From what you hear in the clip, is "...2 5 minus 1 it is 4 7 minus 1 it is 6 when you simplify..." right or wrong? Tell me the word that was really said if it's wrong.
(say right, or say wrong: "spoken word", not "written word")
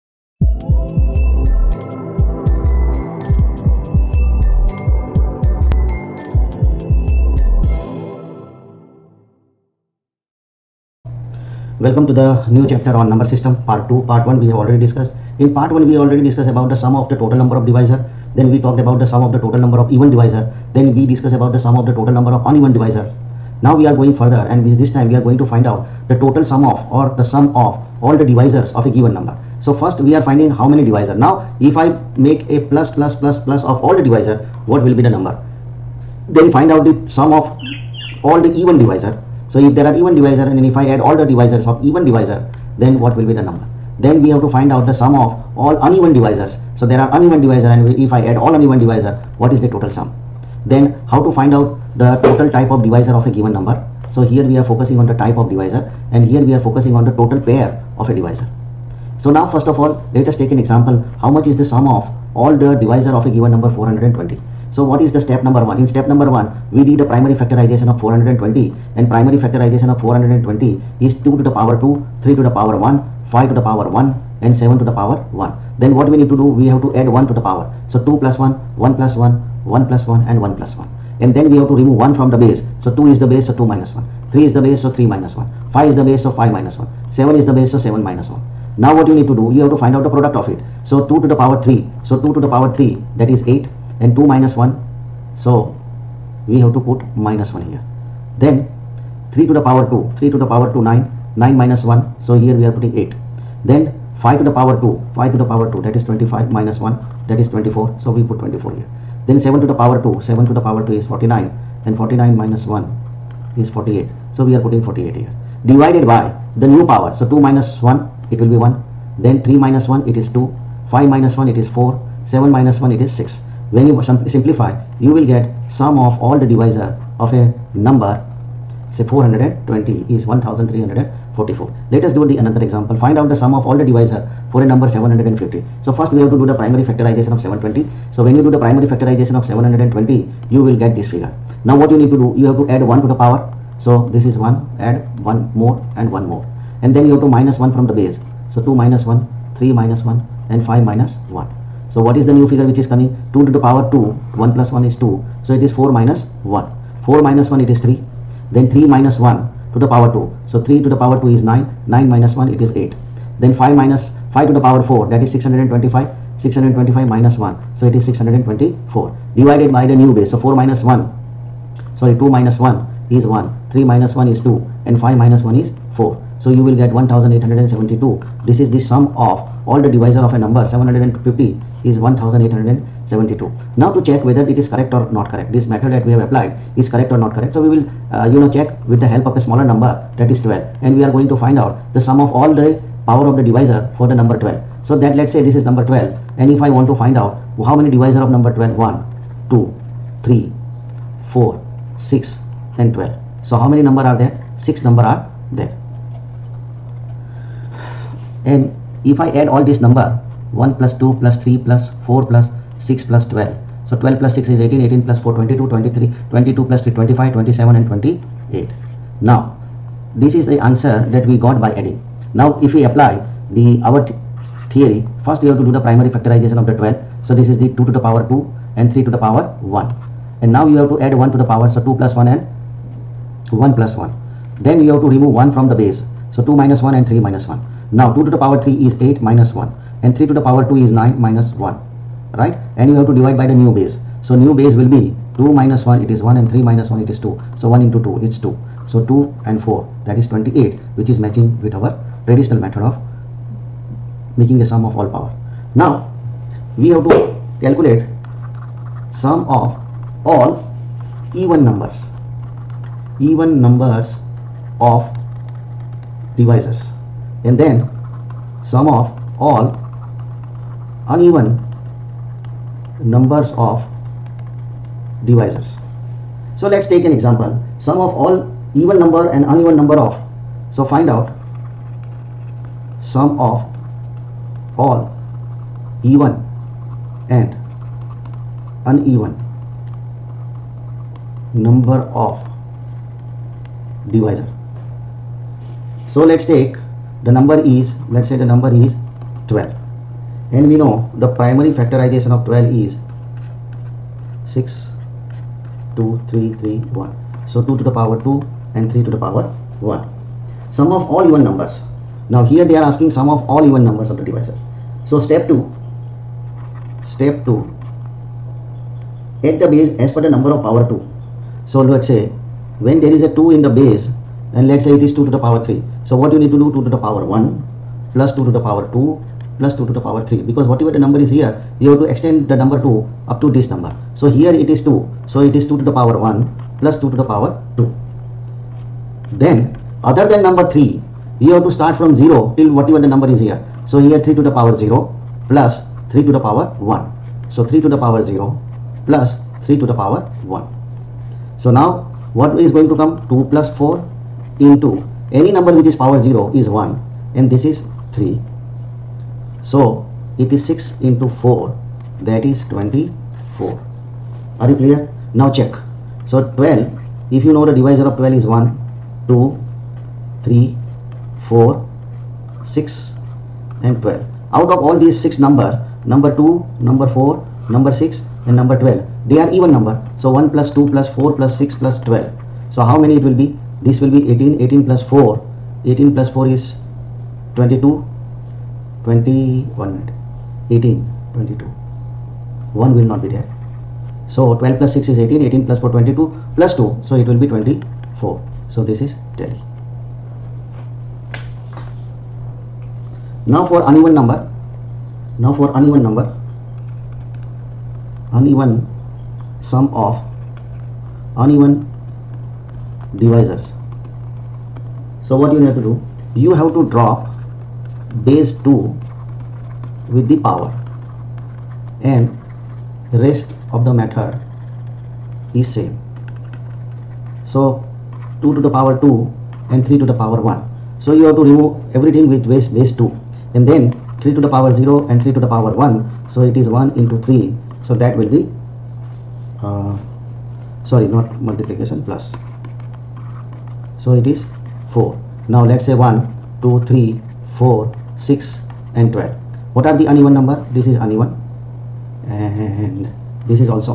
right.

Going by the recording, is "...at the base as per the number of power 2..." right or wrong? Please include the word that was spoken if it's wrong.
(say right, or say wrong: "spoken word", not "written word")
right.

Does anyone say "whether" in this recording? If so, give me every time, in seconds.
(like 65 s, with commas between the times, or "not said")
184 s.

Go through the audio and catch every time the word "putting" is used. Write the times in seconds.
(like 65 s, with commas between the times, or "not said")
102 s, 114 s.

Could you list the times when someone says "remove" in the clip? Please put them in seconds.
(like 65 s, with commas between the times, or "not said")
81 s, 235 s, 431 s.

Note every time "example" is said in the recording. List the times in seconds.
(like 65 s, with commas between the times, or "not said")
60 s, 132 s, 277 s.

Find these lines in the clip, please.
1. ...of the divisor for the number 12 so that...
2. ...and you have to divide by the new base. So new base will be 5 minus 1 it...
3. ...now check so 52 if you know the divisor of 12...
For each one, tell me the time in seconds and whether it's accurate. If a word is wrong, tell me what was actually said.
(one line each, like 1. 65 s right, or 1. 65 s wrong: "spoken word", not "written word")
1. 193 s right
2. 242 s wrong: "2", not "5"
3. 365 s wrong: "12", not "52".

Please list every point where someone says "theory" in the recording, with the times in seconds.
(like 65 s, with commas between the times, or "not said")
224 s.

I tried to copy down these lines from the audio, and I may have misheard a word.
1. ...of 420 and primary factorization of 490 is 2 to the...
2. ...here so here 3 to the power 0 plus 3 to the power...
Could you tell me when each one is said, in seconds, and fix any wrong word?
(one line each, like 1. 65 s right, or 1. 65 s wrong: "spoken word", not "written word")
1. 67 s wrong: "420", not "490"
2. 343 s right.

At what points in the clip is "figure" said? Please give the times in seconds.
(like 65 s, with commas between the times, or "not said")
141 s, 152 s.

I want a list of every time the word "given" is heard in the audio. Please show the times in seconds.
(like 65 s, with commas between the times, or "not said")
28 s, 53 s, 63 s.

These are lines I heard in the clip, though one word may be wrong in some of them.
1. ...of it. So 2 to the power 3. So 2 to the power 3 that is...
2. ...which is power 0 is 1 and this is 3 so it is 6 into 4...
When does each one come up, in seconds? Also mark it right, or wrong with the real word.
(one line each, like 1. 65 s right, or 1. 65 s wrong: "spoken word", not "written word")
1. 90 s right
2. 355 s right.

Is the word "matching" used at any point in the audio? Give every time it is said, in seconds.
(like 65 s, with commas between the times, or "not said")
251 s.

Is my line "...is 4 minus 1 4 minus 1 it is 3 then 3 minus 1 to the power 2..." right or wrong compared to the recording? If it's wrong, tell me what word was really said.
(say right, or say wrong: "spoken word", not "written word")
right.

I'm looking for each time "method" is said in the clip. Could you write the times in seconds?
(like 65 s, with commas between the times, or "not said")
185 s, 252 s, 423 s.